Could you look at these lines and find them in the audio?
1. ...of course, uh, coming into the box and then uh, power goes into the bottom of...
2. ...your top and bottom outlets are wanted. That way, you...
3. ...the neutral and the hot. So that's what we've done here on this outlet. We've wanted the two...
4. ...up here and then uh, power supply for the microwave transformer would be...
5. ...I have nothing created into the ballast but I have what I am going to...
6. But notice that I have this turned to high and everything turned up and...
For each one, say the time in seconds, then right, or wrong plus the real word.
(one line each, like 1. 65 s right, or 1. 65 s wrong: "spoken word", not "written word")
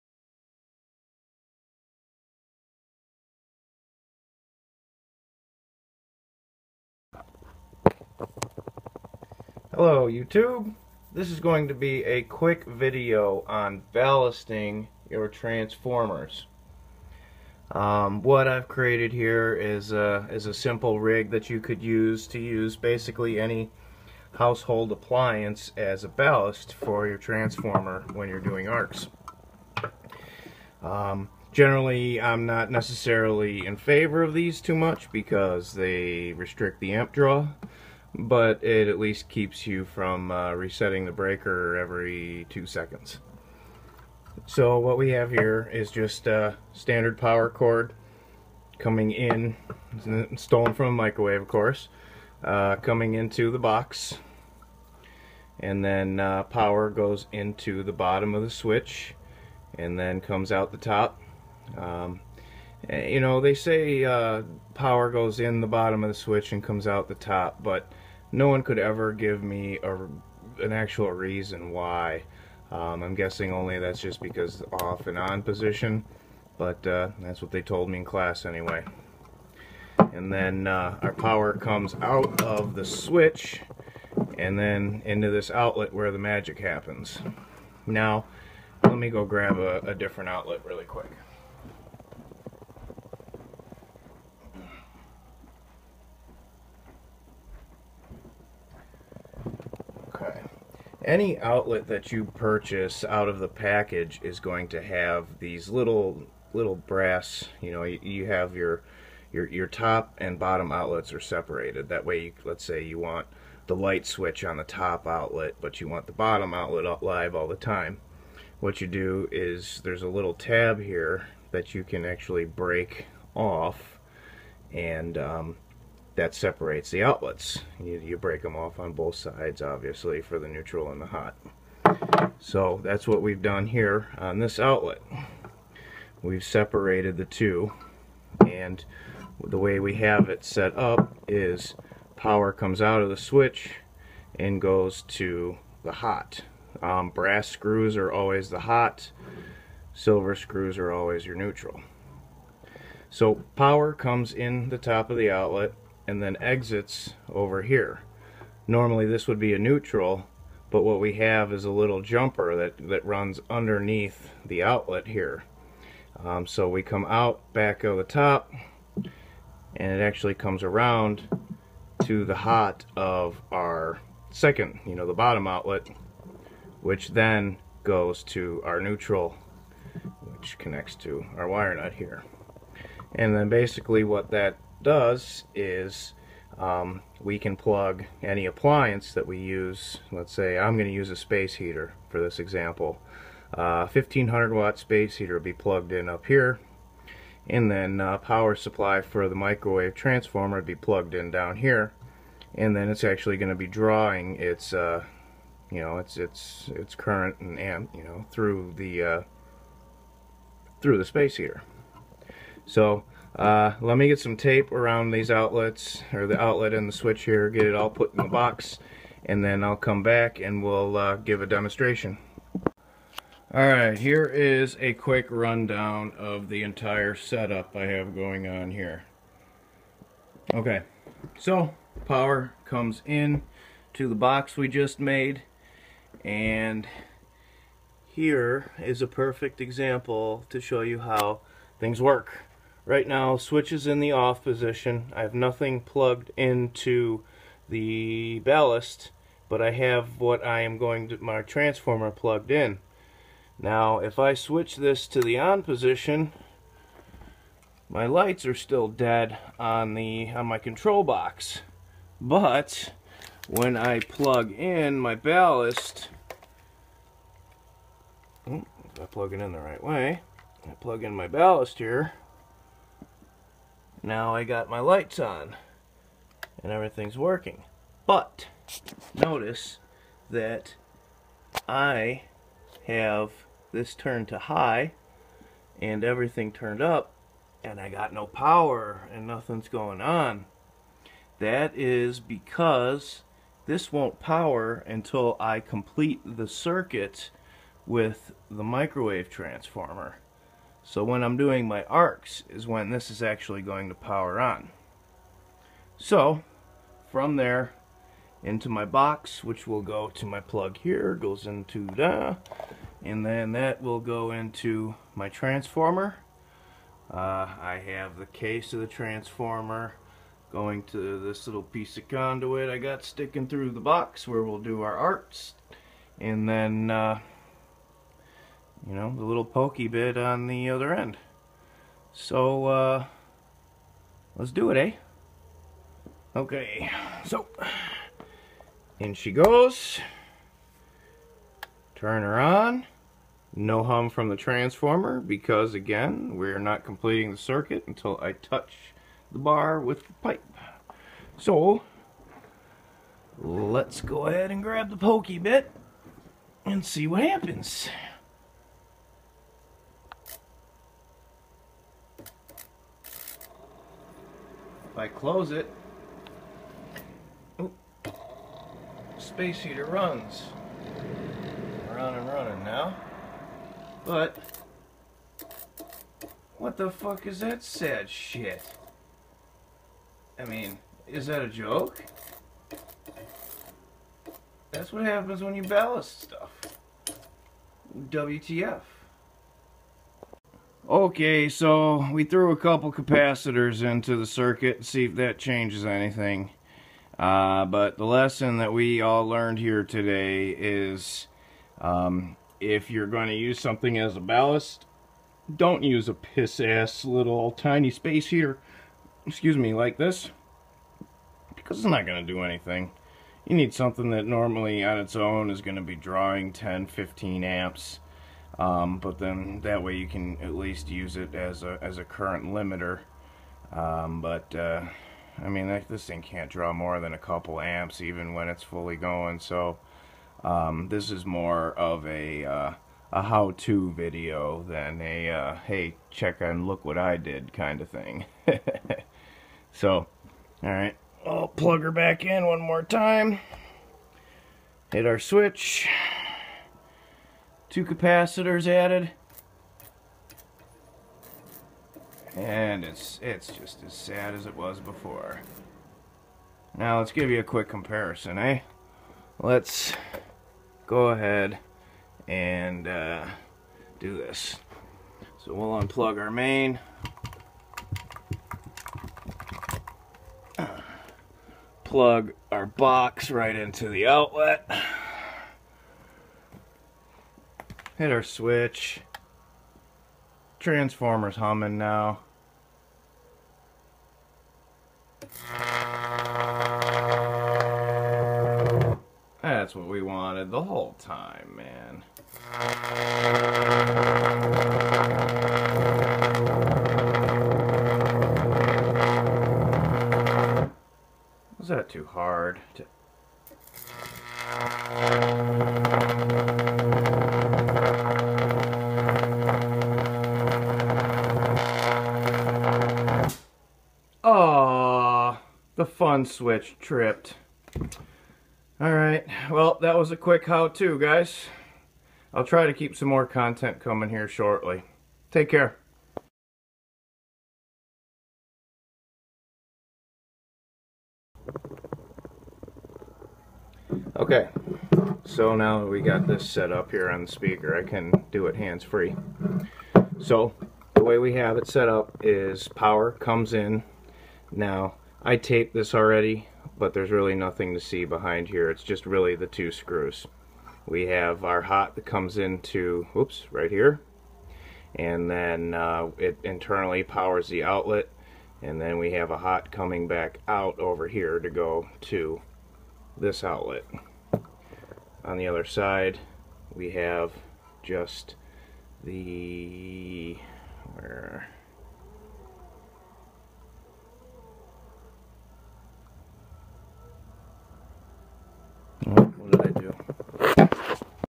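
1. 51 s right
2. 109 s wrong: "separated", not "wanted"
3. 130 s wrong: "separated", not "wanted"
4. 196 s right
5. 245 s wrong: "plugged", not "created"
6. 278 s right.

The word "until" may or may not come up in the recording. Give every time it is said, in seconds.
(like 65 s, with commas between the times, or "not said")
294 s, 347 s.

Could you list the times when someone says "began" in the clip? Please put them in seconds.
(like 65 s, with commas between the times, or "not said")
not said.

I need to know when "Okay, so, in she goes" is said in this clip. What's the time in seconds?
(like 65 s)
336 s.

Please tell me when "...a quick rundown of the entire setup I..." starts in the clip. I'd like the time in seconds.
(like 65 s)
224 s.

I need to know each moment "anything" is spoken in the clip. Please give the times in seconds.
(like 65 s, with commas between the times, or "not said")
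395 s, 412 s.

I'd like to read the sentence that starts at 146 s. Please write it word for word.
Um, brass screws are always the hot, silver screws are always your neutral.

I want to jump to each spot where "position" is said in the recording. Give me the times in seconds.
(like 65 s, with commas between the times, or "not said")
75 s, 244 s, 255 s.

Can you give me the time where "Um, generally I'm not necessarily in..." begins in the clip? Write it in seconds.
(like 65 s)
30 s.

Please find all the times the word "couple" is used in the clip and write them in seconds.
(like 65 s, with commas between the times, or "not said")
392 s, 427 s.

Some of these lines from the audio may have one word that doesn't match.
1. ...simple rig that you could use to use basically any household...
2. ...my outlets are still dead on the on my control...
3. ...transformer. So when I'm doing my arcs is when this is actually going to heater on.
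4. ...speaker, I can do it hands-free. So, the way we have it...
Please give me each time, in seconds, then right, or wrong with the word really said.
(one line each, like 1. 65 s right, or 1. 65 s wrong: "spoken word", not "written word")
1. 20 s right
2. 257 s wrong: "lights", not "outlets"
3. 299 s wrong: "power", not "heater"
4. 537 s right.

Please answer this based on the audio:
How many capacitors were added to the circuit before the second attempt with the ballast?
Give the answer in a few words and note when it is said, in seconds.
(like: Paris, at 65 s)
2, at 447 s.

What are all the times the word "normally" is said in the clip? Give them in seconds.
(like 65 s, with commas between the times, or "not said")
158 s, 414 s.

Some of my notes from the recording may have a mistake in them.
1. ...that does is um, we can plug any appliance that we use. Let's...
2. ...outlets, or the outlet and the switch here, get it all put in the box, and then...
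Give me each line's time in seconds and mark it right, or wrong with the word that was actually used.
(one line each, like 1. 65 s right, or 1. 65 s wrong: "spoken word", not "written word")
1. 184 s right
2. 215 s right.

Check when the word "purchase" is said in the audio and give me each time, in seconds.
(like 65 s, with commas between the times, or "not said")
102 s.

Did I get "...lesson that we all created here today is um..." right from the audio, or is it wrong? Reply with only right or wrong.
wrong.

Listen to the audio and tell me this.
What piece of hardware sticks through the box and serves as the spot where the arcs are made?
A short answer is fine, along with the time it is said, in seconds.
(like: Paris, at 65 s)
conduit, at 321 s.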